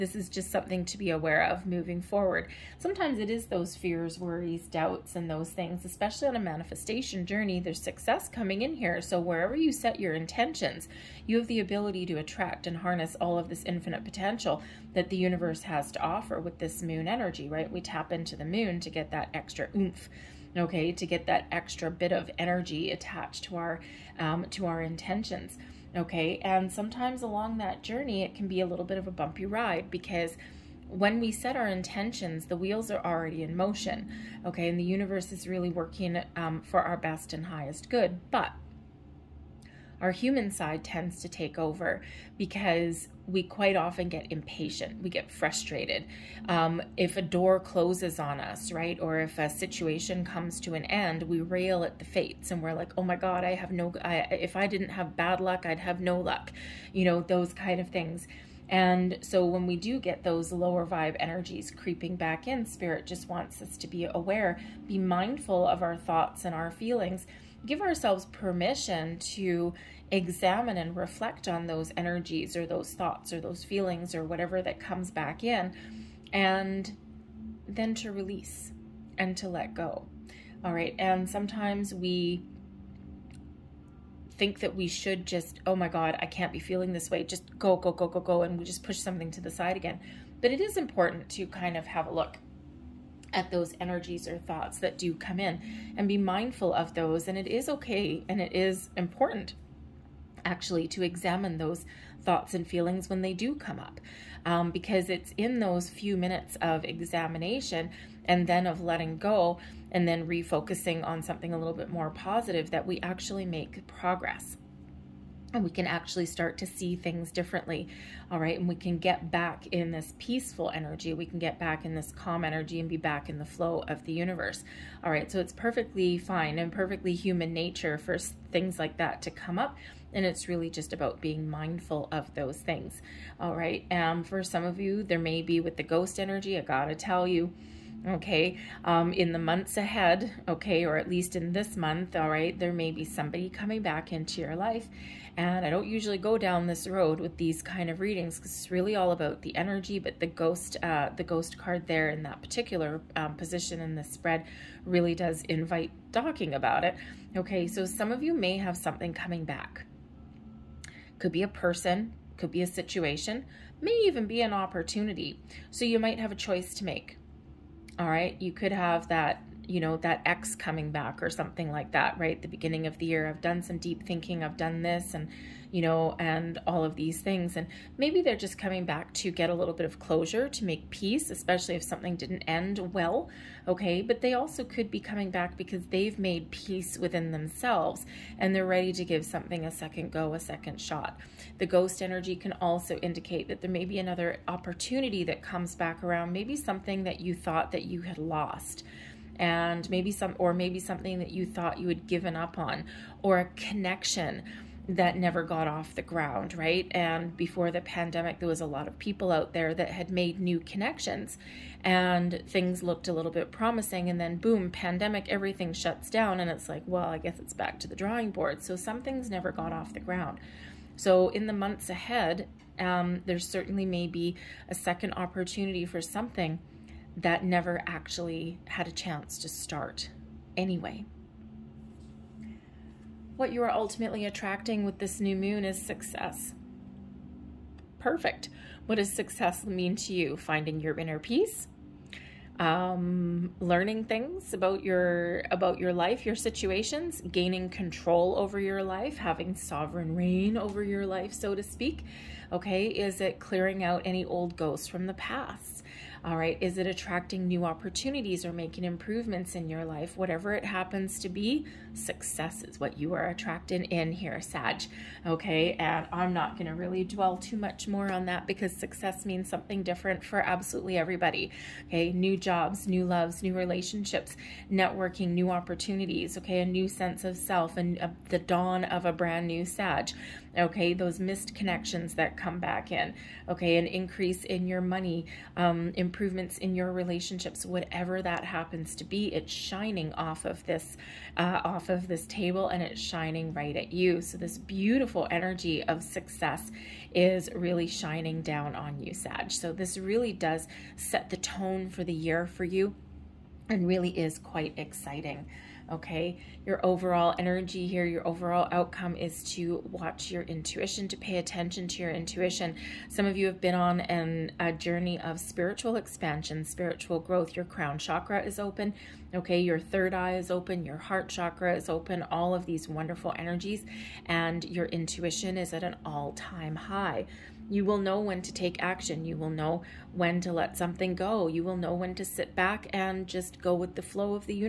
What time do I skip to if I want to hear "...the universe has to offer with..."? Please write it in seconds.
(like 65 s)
15 s.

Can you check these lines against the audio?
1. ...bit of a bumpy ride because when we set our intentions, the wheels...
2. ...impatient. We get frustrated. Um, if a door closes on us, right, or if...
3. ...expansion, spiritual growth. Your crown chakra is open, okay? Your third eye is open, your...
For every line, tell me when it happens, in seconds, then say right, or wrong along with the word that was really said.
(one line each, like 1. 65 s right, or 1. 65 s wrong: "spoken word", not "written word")
1. 28 s right
2. 44 s right
3. 315 s right.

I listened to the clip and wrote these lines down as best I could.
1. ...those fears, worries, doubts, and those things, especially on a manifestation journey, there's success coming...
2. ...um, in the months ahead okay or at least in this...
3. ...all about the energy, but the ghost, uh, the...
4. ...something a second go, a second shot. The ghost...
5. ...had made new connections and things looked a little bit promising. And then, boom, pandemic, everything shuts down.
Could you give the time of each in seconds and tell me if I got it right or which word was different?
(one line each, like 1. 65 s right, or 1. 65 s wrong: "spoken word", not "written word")
1. 3 s right
2. 138 s right
3. 148 s right
4. 189 s right
5. 209 s right.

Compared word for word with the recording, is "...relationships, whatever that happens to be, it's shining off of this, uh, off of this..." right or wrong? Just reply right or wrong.
right.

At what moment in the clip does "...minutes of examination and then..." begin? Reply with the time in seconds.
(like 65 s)
106 s.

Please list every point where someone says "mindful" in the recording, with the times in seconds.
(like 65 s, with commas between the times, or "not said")
64 s, 96 s, 131 s.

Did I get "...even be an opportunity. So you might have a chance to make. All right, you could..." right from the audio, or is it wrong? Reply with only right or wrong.
wrong.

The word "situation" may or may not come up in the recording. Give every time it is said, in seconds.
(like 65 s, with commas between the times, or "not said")
49 s, 162 s, 246 s.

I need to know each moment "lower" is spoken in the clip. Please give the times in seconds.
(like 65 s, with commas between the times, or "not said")
60 s.